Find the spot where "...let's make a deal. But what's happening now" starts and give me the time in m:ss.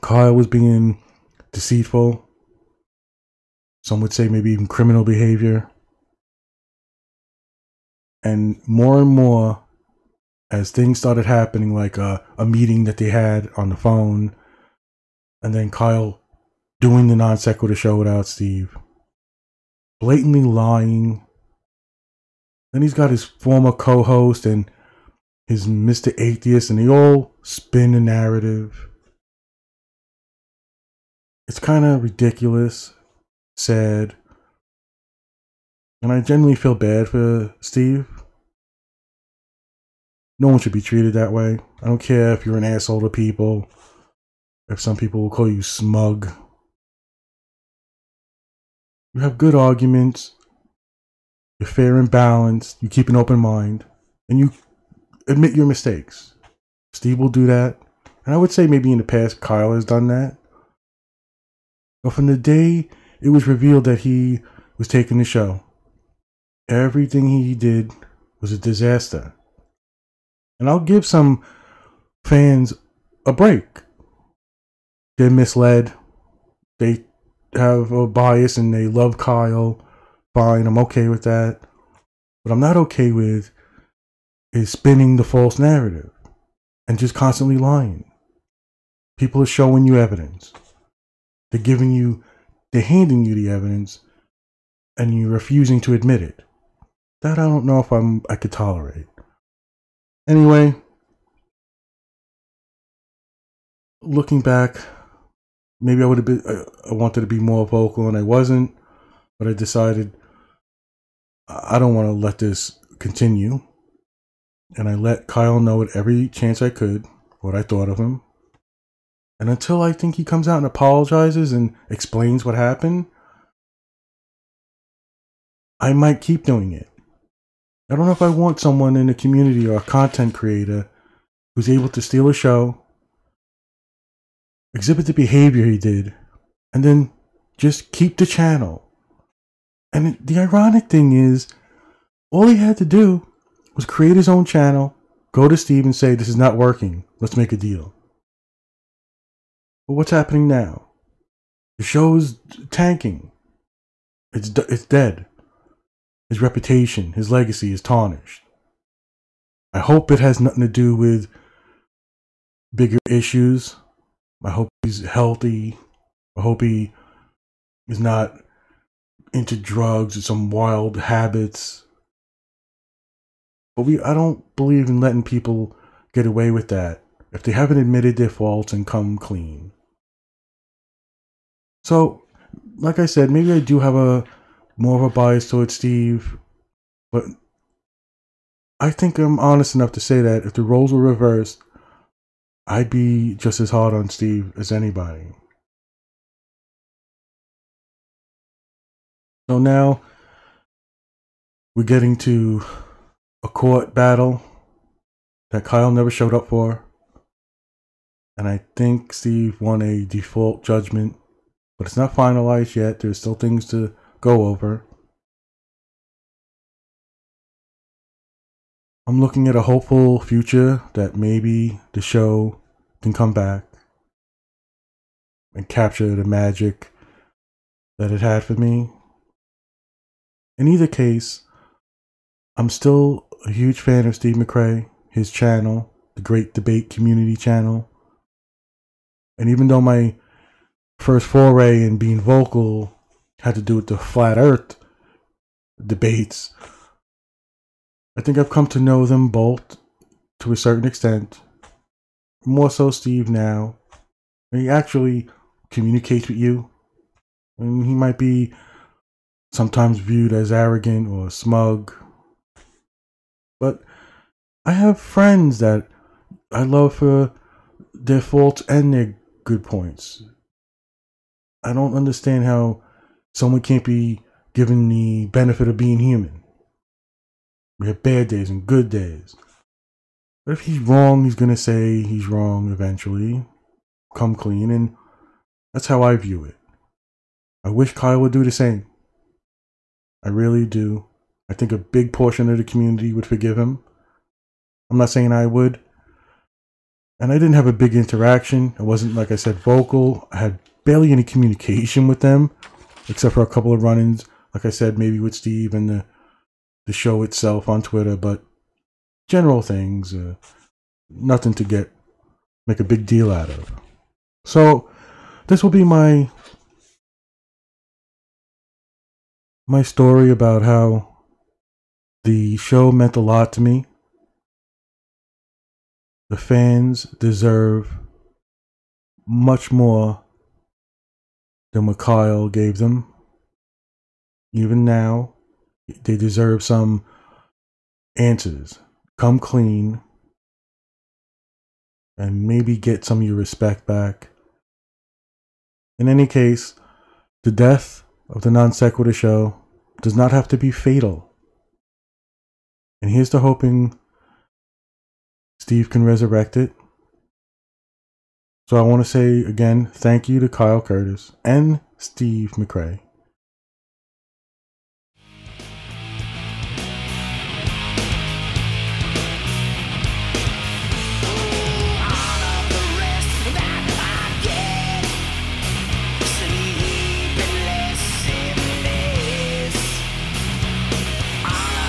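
2:27.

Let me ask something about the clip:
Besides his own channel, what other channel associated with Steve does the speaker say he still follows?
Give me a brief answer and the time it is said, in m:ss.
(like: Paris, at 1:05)
Great Debate Community, at 3:56.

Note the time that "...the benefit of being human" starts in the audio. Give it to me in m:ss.
4:34.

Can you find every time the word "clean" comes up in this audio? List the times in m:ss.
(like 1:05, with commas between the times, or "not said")
2:59, 4:44, 5:39.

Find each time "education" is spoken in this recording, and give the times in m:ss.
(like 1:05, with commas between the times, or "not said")
not said.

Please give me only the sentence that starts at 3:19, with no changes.
So now we're getting to a court battle that Kyle never showed up for.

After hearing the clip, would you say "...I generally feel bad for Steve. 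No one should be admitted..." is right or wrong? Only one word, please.
wrong.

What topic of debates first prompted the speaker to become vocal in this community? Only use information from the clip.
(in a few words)
Flat earth.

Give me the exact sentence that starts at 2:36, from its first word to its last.
His reputation, his legacy is tarnished.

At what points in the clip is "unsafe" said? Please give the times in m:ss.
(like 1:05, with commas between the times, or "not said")
not said.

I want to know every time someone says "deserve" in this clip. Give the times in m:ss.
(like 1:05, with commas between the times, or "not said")
5:27, 5:36.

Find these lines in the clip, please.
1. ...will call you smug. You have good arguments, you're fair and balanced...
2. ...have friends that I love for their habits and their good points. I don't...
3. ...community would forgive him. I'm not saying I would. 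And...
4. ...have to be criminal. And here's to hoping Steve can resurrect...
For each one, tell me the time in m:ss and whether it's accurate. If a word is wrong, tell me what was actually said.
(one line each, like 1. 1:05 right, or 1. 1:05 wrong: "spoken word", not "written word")
1. 0:45 right
2. 4:24 wrong: "faults", not "habits"
3. 4:52 right
4. 5:50 wrong: "fatal", not "criminal".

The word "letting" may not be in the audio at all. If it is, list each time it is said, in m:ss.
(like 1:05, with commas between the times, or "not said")
2:54.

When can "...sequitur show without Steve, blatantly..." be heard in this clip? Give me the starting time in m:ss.
0:17.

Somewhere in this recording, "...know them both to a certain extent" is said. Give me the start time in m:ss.
4:08.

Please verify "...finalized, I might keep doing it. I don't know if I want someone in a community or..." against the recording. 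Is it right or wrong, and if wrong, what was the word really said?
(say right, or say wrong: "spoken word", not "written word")
wrong: "happened", not "finalized".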